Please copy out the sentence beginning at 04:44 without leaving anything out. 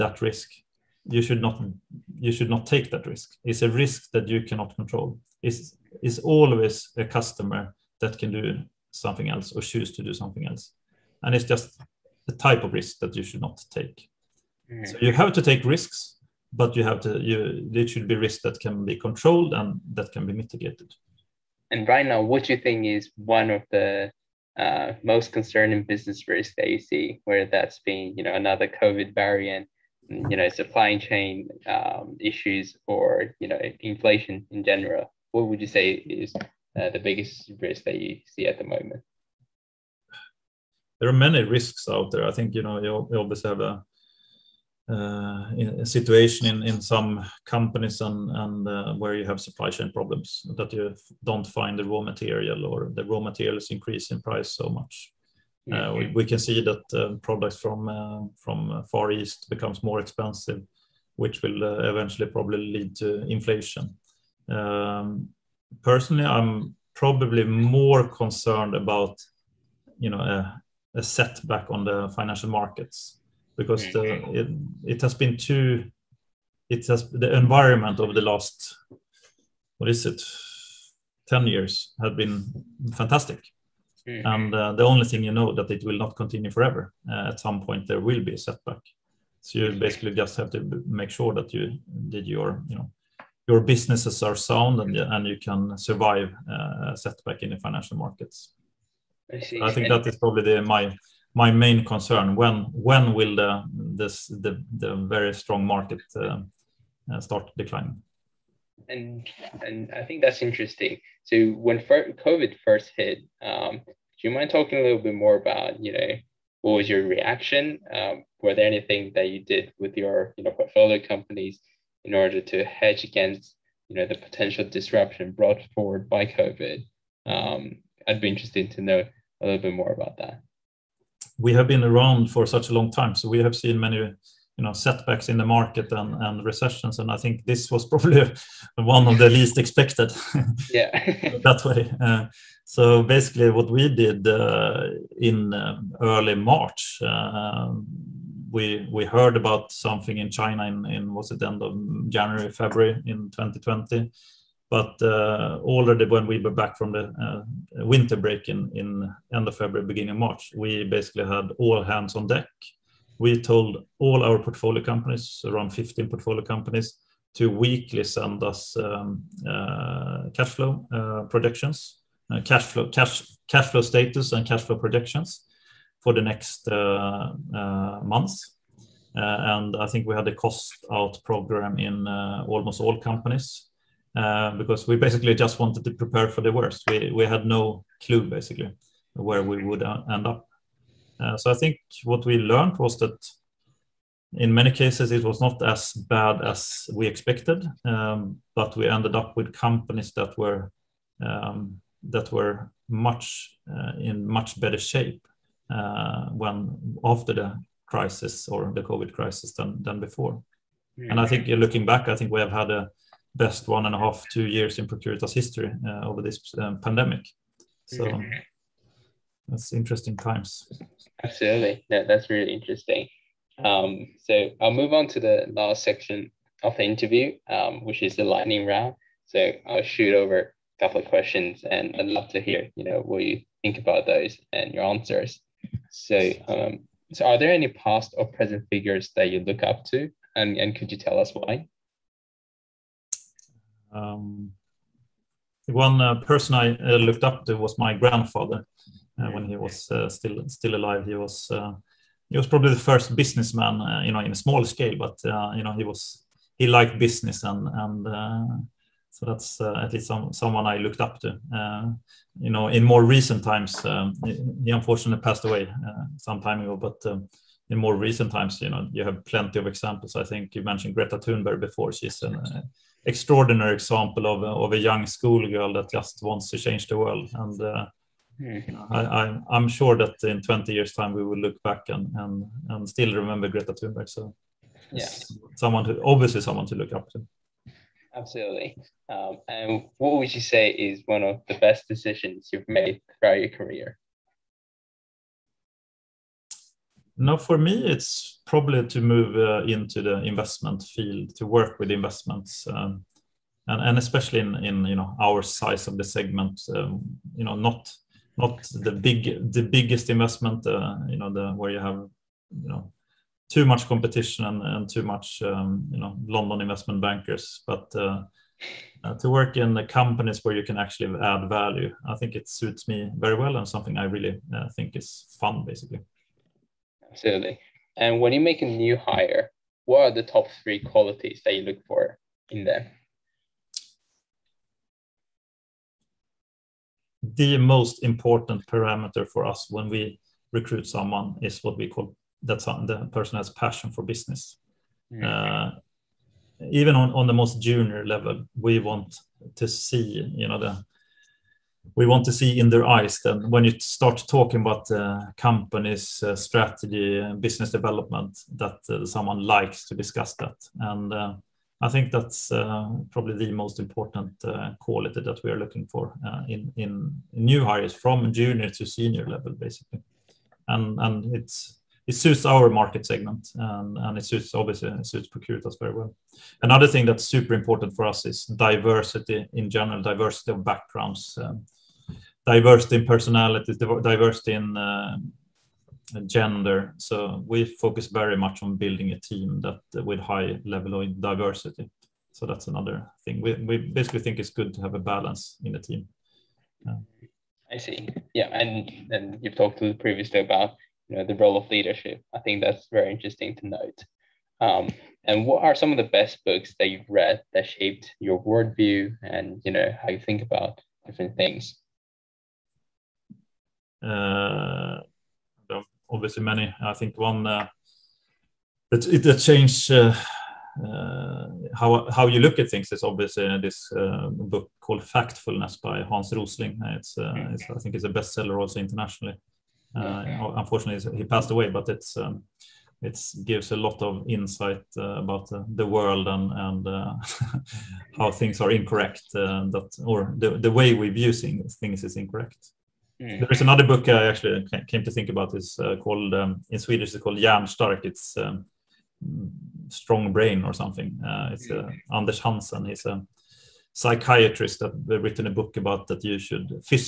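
So, yes, someone who obviously someone to look up to.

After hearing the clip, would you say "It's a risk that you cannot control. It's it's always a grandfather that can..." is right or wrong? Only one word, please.
wrong.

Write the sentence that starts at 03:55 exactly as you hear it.
So, um, so are there any past or present figures that you look up to?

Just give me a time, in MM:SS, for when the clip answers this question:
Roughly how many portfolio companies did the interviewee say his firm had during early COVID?
02:45.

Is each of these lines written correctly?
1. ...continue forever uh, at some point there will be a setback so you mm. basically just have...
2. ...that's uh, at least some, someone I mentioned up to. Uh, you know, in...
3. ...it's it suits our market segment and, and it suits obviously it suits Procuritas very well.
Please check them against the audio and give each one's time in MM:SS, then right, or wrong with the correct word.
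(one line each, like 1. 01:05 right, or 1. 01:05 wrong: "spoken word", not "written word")
1. 01:26 right
2. 04:19 wrong: "looked", not "mentioned"
3. 06:11 right.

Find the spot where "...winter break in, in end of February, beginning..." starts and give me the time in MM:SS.
02:37.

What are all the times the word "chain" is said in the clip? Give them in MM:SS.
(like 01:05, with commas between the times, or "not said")
00:30, 00:49.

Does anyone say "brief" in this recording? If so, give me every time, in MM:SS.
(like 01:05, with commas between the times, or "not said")
not said.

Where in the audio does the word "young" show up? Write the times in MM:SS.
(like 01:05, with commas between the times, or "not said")
04:34.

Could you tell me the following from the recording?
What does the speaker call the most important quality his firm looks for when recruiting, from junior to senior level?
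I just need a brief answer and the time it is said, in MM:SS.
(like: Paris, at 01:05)
passion for business, at 05:43.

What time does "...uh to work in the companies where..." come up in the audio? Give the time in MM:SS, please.
05:19.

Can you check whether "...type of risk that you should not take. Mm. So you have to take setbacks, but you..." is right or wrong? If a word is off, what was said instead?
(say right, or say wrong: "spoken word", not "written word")
wrong: "risks", not "setbacks".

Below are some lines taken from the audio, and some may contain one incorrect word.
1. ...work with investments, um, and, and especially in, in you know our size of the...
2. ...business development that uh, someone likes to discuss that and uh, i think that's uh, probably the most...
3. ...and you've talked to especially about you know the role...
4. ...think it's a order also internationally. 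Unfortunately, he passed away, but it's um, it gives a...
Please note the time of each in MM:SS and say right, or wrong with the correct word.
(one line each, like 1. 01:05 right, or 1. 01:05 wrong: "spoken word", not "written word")
1. 05:01 right
2. 05:57 right
3. 06:39 wrong: "previously", not "especially"
4. 07:07 wrong: "bestseller", not "order".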